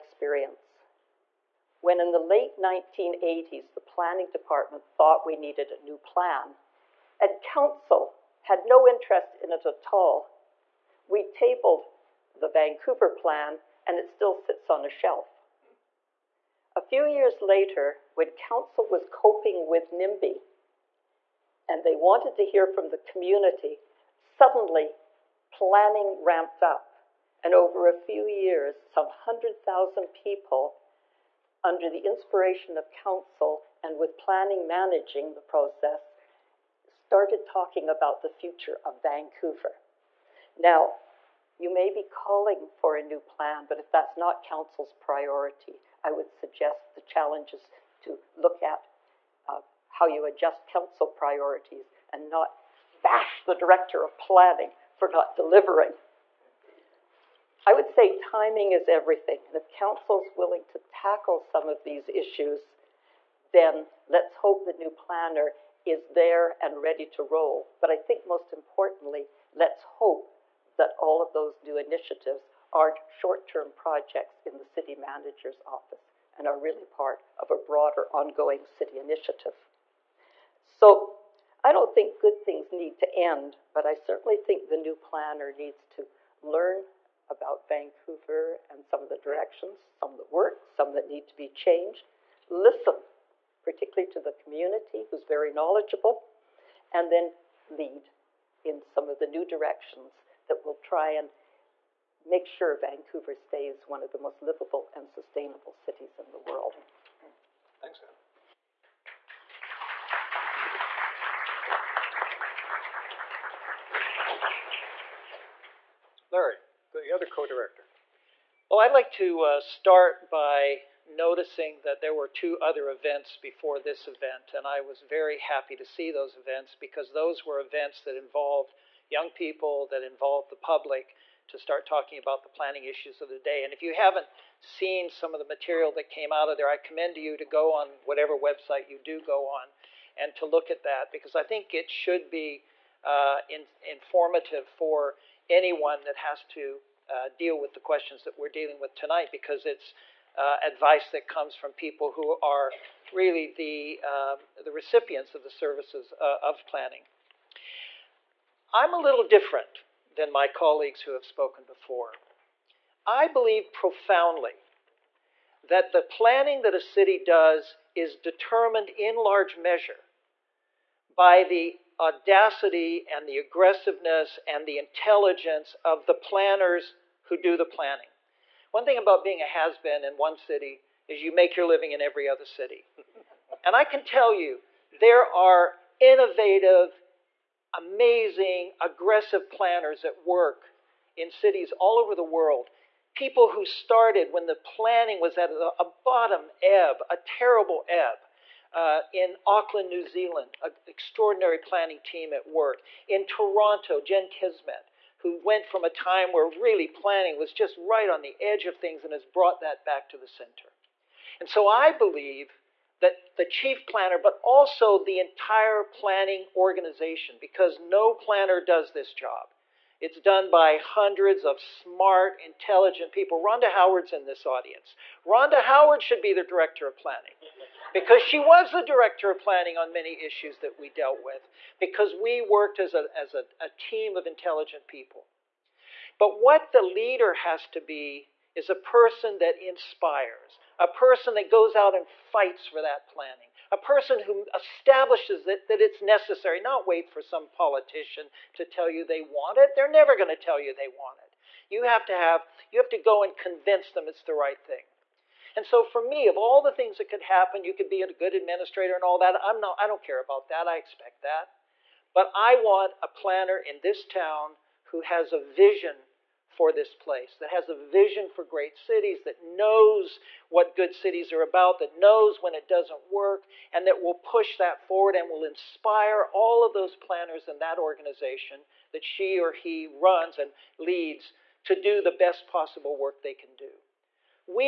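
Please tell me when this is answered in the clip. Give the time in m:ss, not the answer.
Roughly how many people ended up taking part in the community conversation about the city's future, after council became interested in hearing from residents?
0:29.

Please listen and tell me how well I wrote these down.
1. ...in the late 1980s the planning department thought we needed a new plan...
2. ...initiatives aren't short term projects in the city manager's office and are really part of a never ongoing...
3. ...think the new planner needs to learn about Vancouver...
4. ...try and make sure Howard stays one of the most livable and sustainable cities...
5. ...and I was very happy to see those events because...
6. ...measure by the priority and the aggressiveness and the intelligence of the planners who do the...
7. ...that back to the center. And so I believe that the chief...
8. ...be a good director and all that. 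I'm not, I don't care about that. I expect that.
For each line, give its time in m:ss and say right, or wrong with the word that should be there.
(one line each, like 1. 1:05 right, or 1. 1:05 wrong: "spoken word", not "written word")
1. 0:01 right
2. 1:11 wrong: "broader", not "never"
3. 1:24 right
4. 1:40 wrong: "Vancouver", not "Howard"
5. 2:04 right
6. 2:49 wrong: "audacity", not "priority"
7. 3:29 right
8. 4:17 wrong: "administrator", not "director".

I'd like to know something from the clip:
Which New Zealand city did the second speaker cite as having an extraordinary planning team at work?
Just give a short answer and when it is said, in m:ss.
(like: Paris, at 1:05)
Auckland, at 3:19.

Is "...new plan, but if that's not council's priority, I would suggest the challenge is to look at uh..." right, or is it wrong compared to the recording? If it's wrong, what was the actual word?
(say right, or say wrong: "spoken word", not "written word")
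right.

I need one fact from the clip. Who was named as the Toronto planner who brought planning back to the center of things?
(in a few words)
Jen Keesmaat.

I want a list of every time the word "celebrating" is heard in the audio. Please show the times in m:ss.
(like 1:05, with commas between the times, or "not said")
not said.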